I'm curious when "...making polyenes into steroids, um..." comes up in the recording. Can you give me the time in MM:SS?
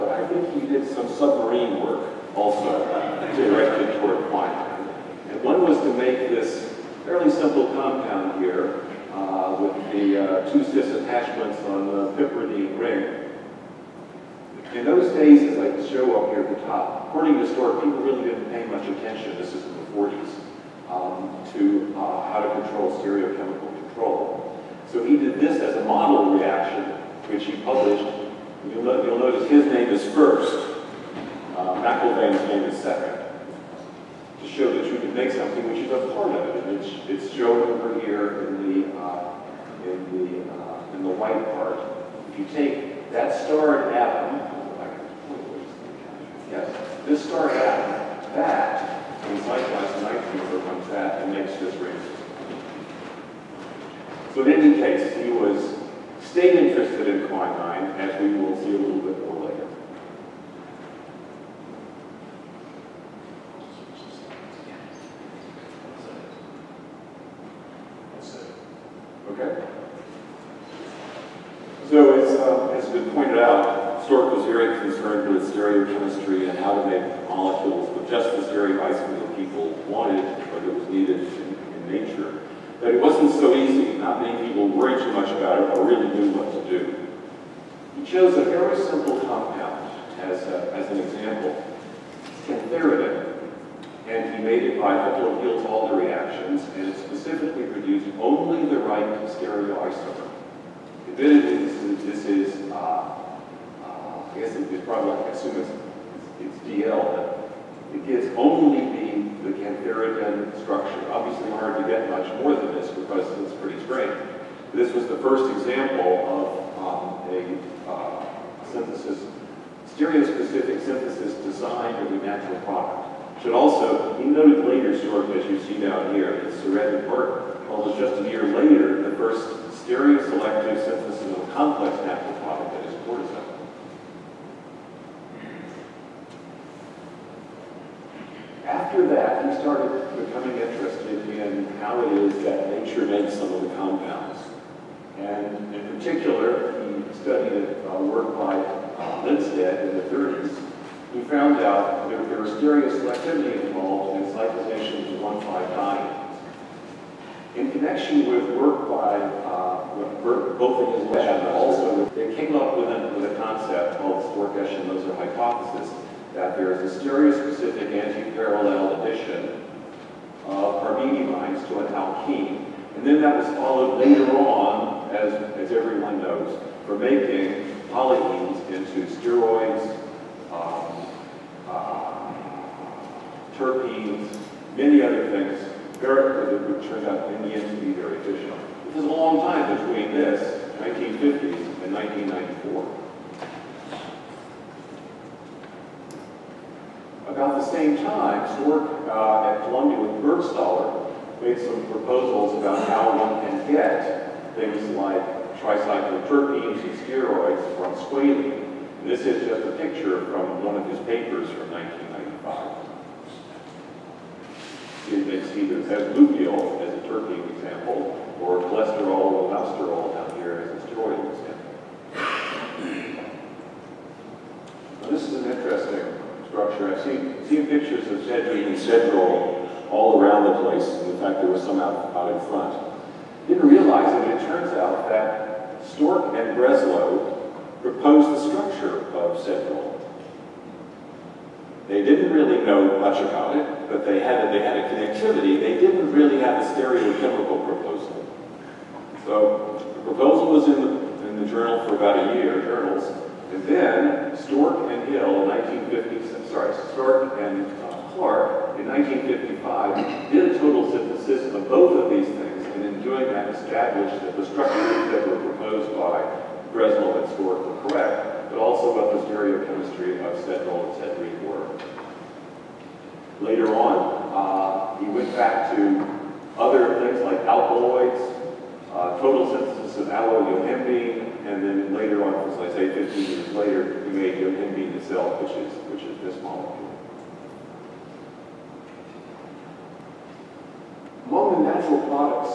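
02:56.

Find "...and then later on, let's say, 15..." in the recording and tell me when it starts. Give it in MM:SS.
04:41.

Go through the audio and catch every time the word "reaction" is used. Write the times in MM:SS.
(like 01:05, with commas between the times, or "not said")
00:26, 01:35.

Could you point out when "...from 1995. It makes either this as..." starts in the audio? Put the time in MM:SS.
03:31.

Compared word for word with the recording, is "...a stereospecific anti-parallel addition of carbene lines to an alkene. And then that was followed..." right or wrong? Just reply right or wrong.
right.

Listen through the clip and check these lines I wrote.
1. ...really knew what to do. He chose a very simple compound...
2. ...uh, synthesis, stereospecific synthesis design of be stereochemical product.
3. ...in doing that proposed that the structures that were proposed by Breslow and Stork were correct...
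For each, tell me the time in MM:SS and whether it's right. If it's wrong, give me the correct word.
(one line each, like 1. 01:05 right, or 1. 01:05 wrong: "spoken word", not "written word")
1. 01:25 right
2. 01:57 wrong: "natural", not "stereochemical"
3. 04:22 wrong: "established", not "proposed".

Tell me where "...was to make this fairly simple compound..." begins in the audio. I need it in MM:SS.
00:05.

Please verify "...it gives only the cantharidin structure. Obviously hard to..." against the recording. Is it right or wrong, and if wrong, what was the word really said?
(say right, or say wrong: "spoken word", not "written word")
right.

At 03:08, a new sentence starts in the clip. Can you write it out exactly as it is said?
This is a long time between this, 1950s, and 1994.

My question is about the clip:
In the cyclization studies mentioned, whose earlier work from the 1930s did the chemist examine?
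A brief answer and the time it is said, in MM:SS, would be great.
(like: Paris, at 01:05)
Lindstedt, at 02:29.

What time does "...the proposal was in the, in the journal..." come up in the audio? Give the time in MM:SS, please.
04:09.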